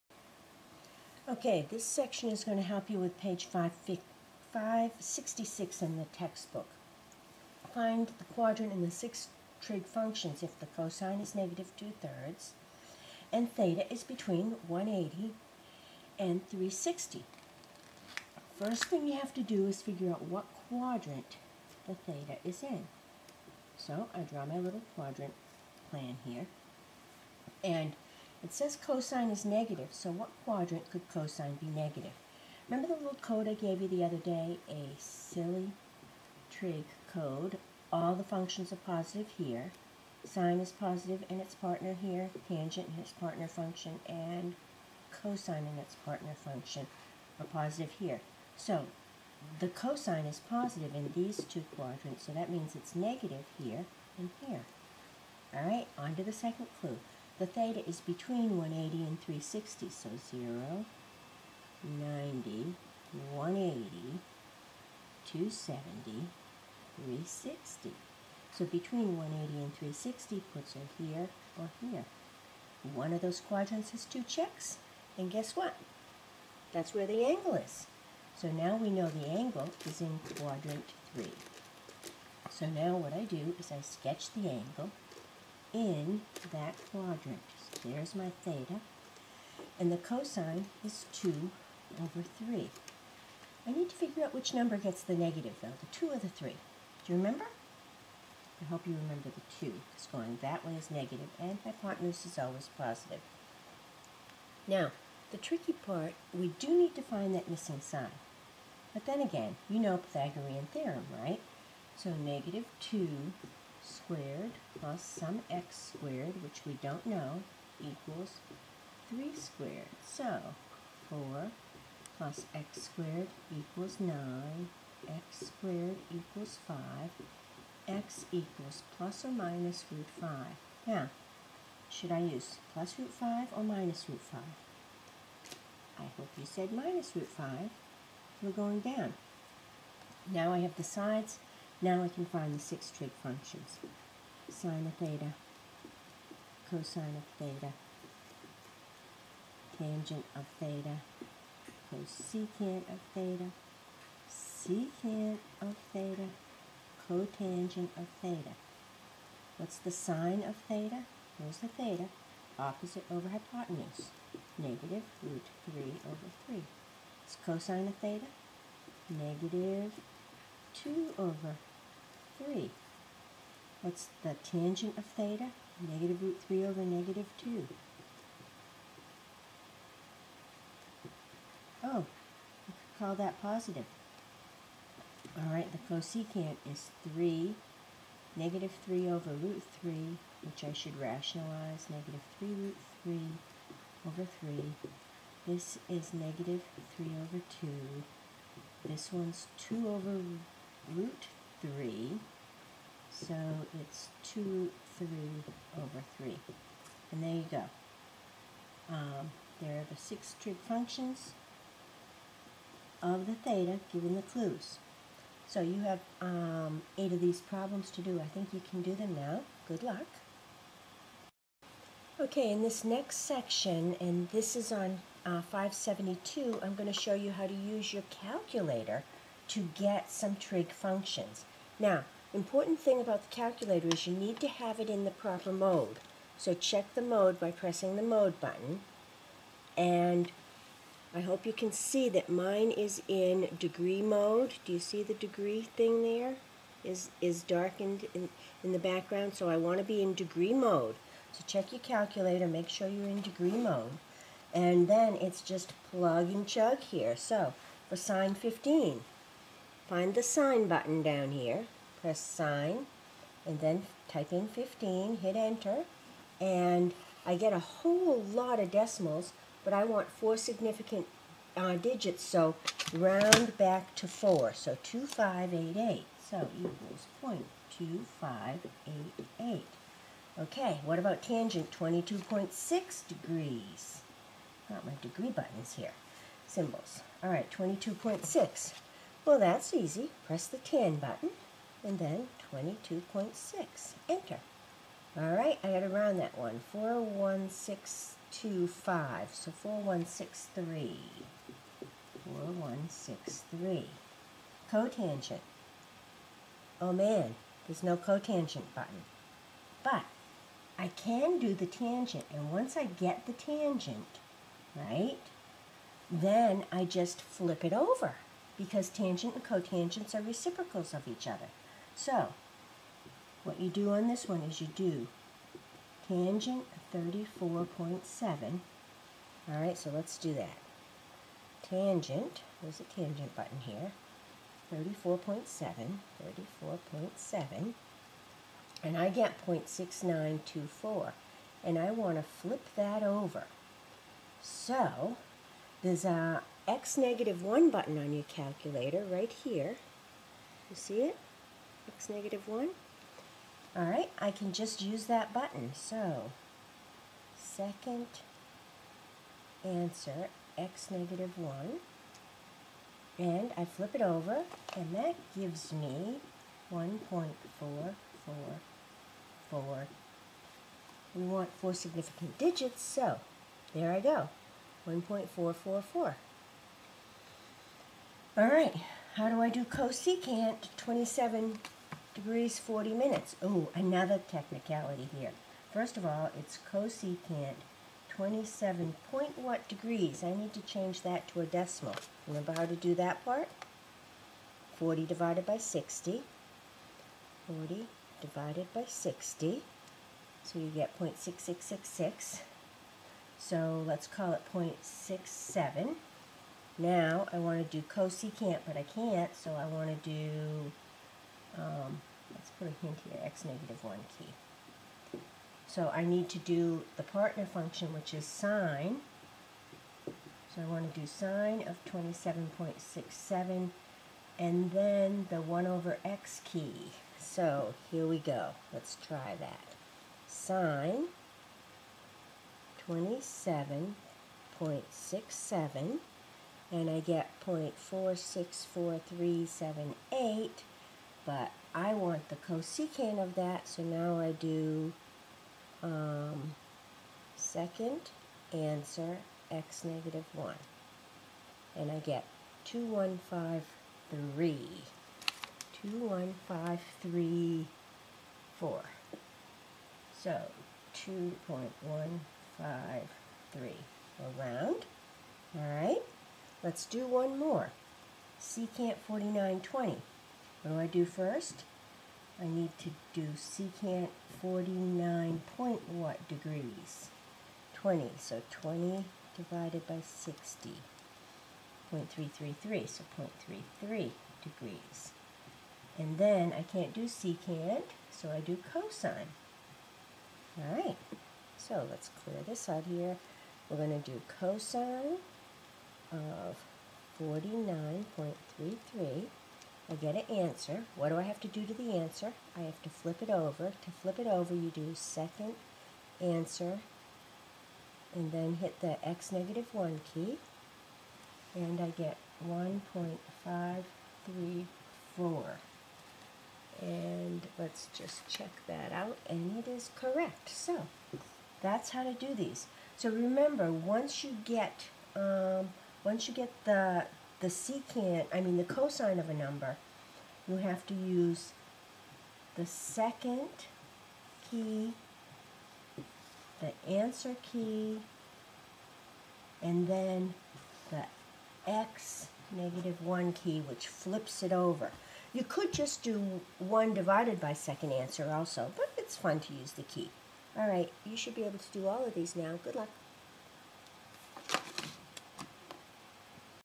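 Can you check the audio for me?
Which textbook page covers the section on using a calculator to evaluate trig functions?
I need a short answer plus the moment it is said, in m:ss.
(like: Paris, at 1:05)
572, at 3:45.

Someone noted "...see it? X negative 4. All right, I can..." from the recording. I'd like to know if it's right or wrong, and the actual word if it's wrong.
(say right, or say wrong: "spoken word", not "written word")
wrong: "1", not "4".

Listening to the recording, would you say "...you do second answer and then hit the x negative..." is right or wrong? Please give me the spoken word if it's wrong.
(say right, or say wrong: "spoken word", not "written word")
right.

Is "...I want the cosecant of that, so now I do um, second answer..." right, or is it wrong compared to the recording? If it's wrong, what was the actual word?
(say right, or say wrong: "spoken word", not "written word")
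right.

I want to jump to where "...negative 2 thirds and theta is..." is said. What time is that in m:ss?
0:11.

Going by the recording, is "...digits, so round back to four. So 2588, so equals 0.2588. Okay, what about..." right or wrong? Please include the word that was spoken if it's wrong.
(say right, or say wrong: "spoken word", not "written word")
right.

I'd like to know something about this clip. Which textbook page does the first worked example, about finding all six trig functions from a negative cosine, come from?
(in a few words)
566.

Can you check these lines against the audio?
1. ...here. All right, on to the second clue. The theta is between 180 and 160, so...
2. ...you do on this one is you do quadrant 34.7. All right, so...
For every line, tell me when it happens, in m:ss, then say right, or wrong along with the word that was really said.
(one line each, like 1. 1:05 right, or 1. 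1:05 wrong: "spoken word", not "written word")
1. 0:54 wrong: "360", not "160"
2. 5:23 wrong: "tangent", not "quadrant".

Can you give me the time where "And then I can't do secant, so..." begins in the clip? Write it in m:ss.
8:05.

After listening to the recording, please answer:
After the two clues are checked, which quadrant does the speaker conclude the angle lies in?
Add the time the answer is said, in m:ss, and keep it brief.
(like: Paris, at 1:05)
quadrant 3, at 1:20.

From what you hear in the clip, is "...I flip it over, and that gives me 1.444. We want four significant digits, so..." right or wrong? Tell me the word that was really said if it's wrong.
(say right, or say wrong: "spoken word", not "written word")
right.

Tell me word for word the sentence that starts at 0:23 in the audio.
So I draw my little quadrant plan here and it says cosine is negative, so what quadrant could cosine be negative?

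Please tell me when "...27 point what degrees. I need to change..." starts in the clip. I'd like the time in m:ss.
6:28.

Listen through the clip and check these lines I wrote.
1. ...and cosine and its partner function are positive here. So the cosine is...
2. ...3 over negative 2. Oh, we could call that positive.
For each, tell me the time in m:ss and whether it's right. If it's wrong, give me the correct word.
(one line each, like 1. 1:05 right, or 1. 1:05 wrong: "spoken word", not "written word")
1. 0:44 right
2. 2:56 right.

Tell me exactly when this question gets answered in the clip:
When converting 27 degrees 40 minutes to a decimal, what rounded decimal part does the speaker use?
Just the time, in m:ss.
6:44.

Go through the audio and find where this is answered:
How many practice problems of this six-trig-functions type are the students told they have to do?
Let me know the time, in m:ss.
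3:36.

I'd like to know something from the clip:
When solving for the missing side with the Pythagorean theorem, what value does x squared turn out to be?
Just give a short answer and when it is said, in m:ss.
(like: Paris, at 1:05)
5, at 2:05.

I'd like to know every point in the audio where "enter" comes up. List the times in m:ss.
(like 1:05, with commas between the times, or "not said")
4:25, 4:54.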